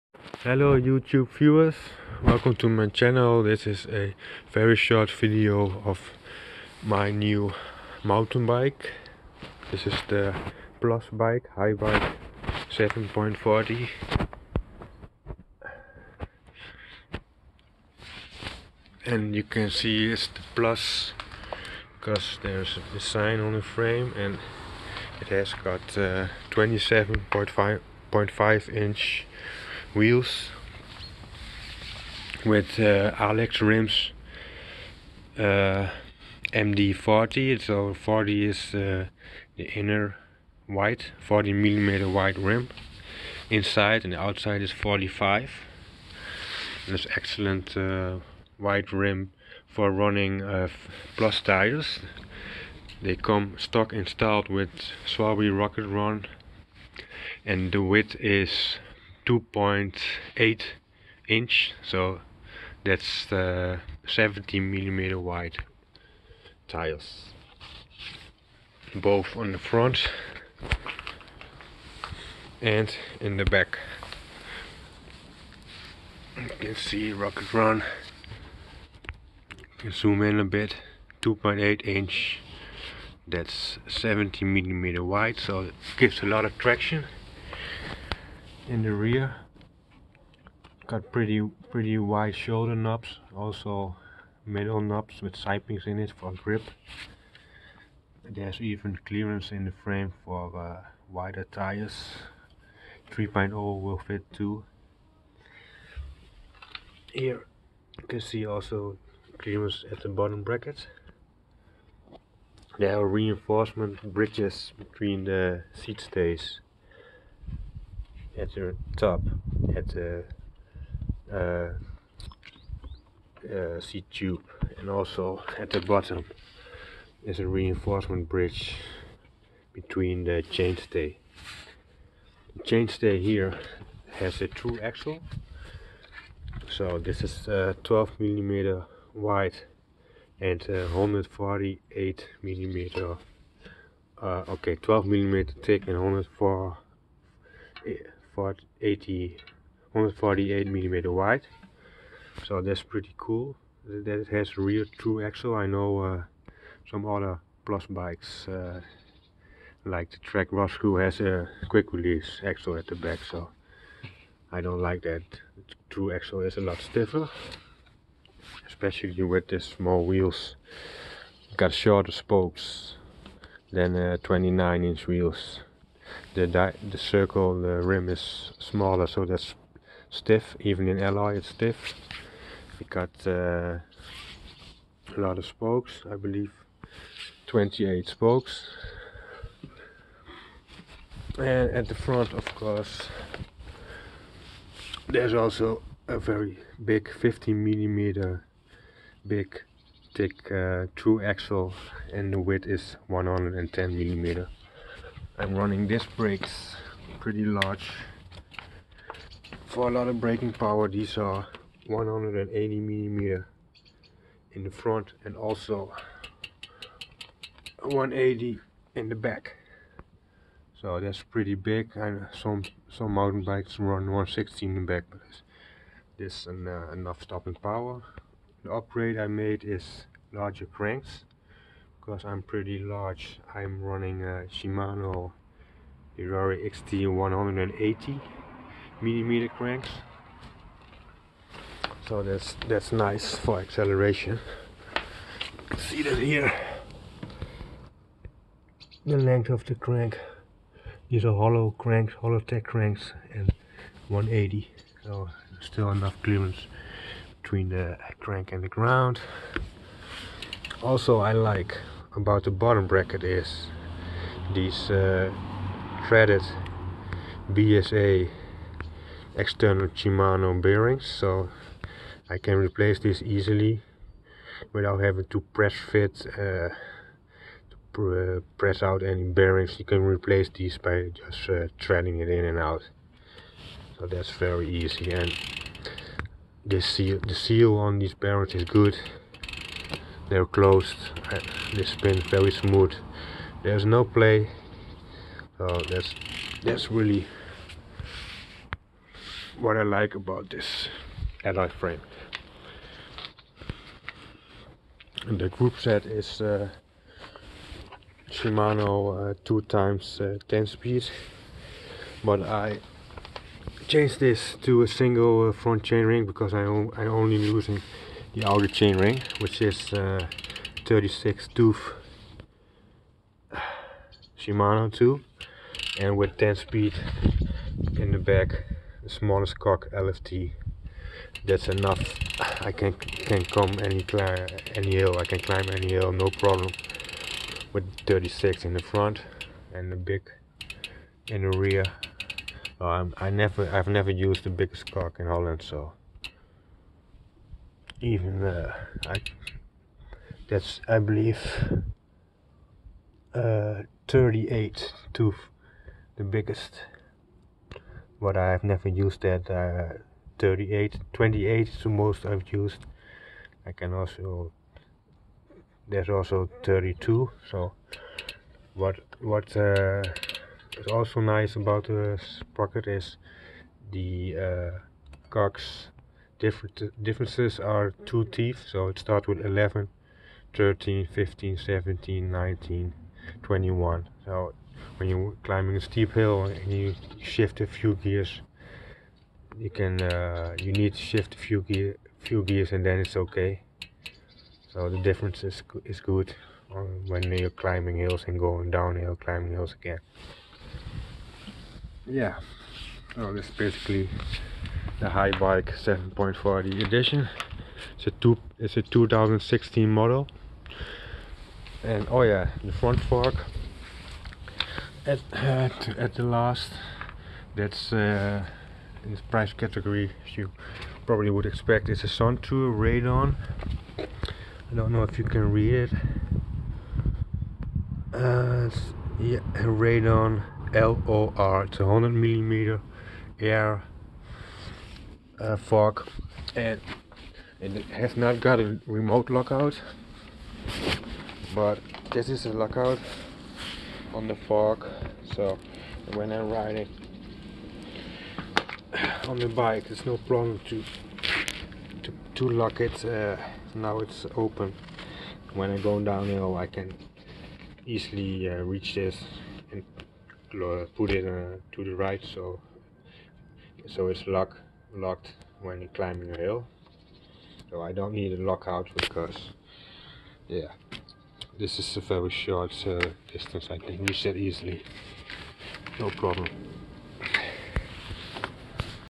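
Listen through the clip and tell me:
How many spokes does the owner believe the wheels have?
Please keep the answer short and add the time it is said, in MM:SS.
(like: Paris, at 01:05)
28, at 03:07.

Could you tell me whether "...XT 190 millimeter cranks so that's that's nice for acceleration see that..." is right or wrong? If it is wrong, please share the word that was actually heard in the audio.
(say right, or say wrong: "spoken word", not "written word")
wrong: "180", not "190".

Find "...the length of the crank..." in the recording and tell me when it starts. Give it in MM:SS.
04:09.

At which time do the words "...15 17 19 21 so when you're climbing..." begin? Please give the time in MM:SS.
06:21.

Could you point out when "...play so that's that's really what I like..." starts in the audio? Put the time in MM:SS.
04:54.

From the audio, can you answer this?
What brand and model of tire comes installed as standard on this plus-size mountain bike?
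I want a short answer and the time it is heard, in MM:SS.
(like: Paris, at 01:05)
Schwalbe Rocket Ron, at 00:55.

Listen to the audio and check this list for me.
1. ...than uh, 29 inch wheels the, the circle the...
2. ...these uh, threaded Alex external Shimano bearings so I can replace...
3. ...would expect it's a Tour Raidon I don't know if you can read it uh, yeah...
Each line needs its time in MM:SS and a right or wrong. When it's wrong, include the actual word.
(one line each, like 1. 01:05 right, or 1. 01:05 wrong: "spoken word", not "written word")
1. 02:53 right
2. 04:24 wrong: "BSA", not "Alex"
3. 07:01 right.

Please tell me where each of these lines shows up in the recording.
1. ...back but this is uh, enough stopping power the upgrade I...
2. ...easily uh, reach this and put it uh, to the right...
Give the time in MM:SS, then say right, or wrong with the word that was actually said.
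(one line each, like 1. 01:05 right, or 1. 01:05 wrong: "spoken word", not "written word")
1. 03:44 right
2. 07:37 right.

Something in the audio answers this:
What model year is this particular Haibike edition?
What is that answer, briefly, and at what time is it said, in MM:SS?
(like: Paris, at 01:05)
2016, at 06:48.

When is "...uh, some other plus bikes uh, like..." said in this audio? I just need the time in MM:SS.
02:35.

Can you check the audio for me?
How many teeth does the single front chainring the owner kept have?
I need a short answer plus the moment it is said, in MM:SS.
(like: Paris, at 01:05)
36, at 05:20.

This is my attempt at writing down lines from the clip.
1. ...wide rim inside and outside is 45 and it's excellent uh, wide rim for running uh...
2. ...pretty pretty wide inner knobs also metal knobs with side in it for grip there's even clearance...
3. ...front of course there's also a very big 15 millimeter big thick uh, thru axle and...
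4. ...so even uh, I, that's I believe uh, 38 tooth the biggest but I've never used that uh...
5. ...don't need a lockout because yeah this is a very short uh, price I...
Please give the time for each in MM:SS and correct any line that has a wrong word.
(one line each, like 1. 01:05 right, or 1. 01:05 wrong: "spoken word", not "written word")
1. 00:42 right
2. 01:31 wrong: "shoulder", not "inner"
3. 03:11 right
4. 05:45 right
5. 07:47 wrong: "distance", not "price".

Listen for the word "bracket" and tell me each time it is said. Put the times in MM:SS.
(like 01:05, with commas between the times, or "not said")
01:50, 04:22.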